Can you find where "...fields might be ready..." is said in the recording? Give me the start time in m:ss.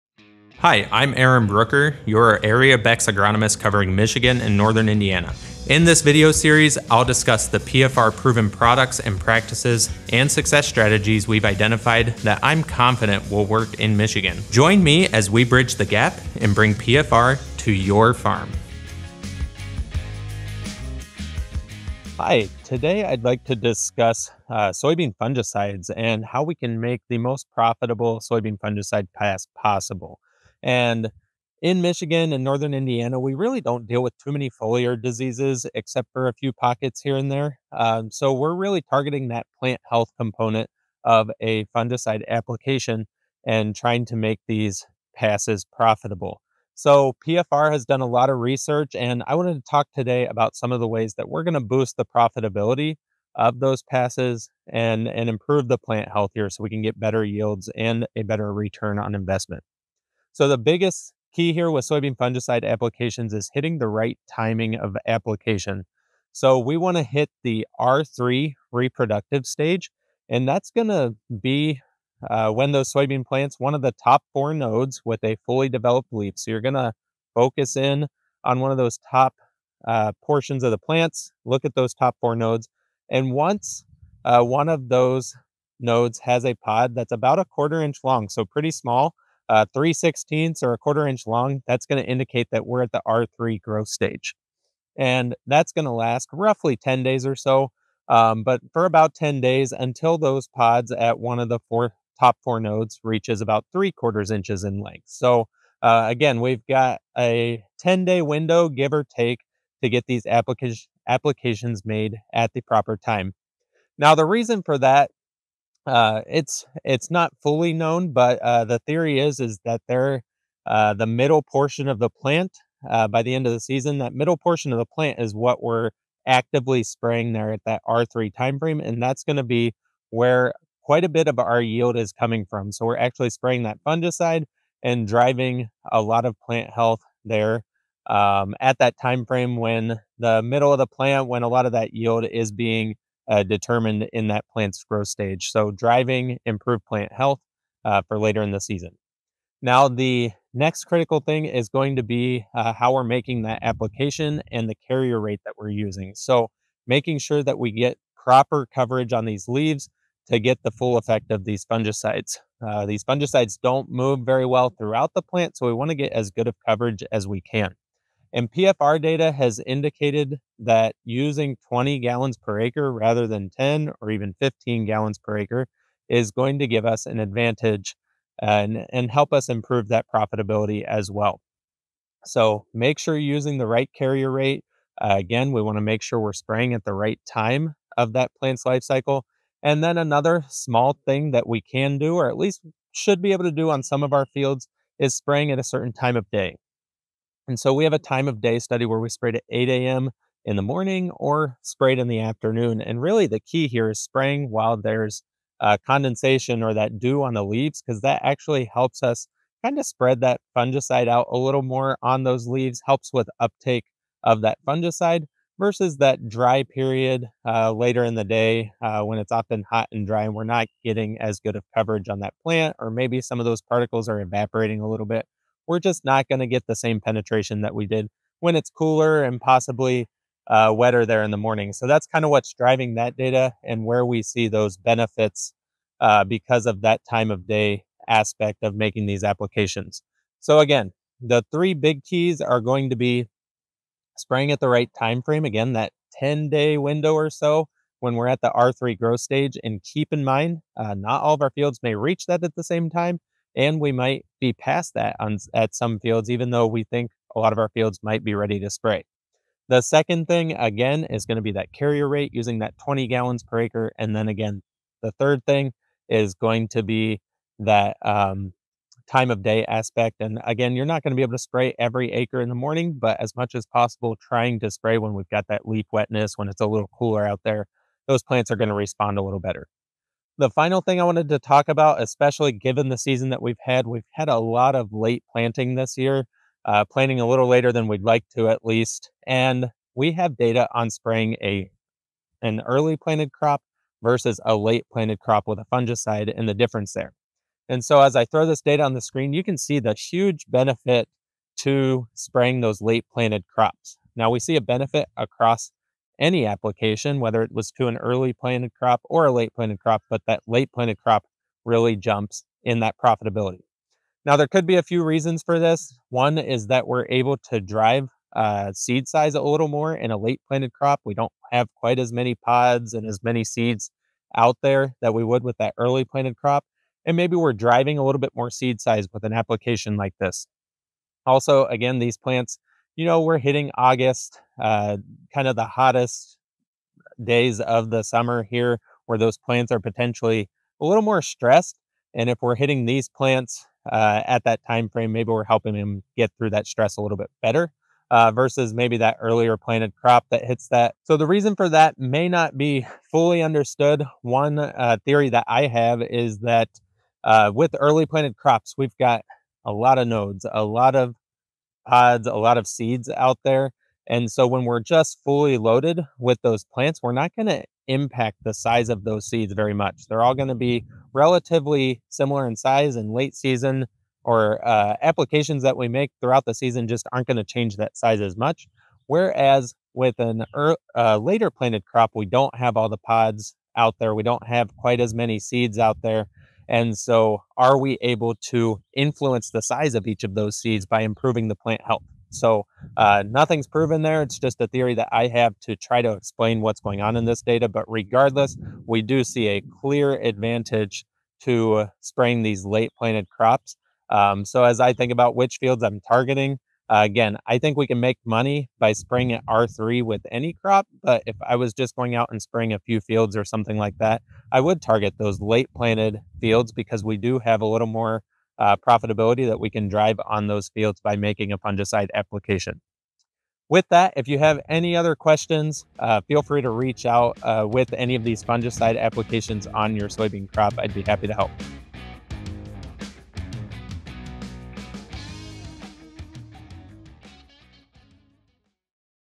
4:17.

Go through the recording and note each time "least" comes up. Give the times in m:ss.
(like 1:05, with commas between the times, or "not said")
3:12, 4:48.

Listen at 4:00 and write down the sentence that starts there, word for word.
So again, the three big keys are going to be spraying at the right time frame.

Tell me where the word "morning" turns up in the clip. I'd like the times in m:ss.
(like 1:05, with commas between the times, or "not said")
3:20, 3:51, 4:32.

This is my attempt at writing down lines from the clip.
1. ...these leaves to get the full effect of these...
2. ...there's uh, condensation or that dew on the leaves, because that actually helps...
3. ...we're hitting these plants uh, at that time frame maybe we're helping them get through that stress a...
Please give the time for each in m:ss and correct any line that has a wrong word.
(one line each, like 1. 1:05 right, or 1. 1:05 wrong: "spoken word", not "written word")
1. 2:39 right
2. 3:24 right
3. 5:42 right.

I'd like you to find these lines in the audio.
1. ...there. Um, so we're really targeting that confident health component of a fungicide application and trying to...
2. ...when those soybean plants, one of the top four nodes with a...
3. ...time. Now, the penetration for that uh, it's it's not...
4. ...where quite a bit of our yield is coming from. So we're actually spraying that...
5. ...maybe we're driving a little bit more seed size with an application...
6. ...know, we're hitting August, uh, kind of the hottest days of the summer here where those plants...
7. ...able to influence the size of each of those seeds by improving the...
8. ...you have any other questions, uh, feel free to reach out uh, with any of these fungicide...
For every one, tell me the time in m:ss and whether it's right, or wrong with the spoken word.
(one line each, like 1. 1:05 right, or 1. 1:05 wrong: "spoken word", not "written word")
1. 0:37 wrong: "plant", not "confident"
2. 1:12 right
3. 1:52 wrong: "reason", not "penetration"
4. 2:10 right
5. 5:27 right
6. 5:33 right
7. 6:28 right
8. 7:04 right.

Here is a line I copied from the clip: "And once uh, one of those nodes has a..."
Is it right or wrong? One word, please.
right.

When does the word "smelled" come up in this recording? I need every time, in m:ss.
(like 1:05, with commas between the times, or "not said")
not said.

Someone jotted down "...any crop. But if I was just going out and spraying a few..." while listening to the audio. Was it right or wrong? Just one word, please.
right.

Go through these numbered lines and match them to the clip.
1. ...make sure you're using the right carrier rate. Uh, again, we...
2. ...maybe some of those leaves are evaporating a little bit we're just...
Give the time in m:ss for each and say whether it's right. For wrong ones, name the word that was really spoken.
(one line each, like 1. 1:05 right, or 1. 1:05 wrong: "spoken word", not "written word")
1. 3:02 right
2. 3:42 wrong: "particles", not "leaves".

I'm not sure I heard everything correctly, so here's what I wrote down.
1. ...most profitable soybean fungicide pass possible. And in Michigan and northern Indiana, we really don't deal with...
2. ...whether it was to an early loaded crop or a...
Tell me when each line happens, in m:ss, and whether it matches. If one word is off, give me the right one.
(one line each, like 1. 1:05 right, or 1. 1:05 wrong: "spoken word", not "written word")
1. 0:27 right
2. 5:07 wrong: "planted", not "loaded".